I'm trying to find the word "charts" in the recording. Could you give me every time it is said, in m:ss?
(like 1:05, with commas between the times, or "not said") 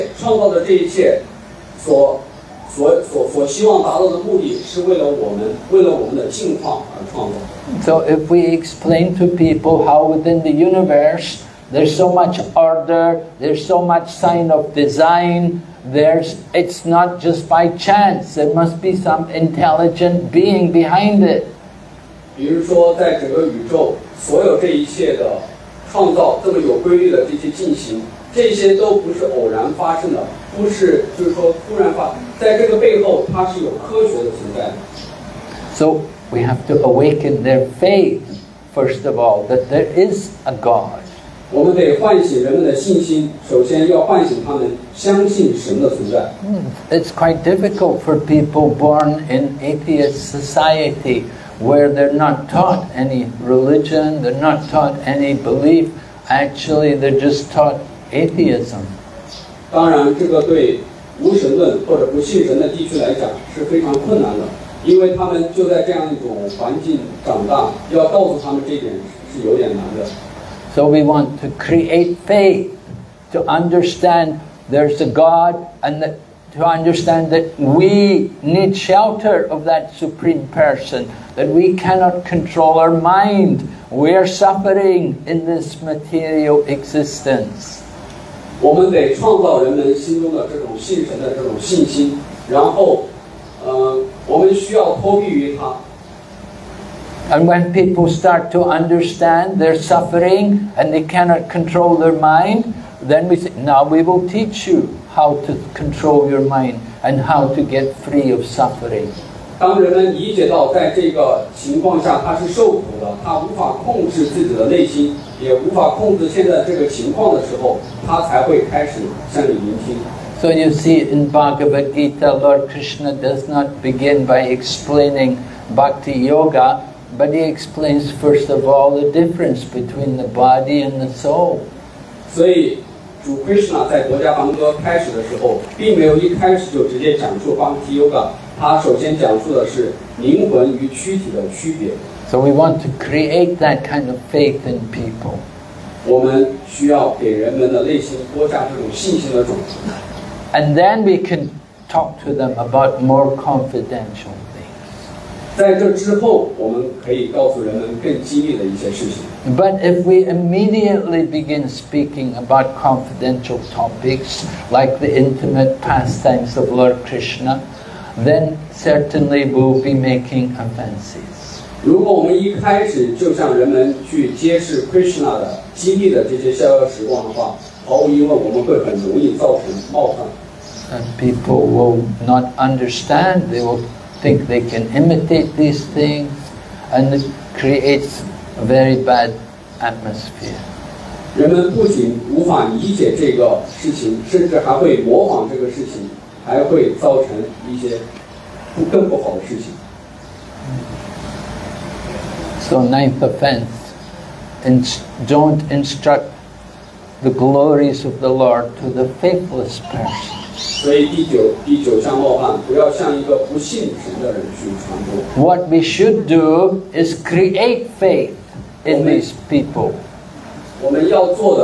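not said.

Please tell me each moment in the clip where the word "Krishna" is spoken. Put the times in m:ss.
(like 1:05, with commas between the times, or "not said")
2:02, 2:47, 2:54.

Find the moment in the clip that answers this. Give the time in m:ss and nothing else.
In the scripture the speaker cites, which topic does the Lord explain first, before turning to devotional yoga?
2:09.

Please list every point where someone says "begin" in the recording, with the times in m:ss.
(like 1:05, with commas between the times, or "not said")
2:03, 2:41.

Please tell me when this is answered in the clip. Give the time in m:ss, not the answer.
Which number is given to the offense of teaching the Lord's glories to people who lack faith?
3:22.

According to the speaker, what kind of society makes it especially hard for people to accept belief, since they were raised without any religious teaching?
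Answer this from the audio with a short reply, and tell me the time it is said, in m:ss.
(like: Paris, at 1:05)
Atheist society, at 0:49.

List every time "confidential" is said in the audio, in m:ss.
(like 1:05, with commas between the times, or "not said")
2:33, 2:42.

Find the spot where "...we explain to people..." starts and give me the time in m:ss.
0:08.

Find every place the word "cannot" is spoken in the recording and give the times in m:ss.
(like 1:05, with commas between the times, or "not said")
1:21, 1:41.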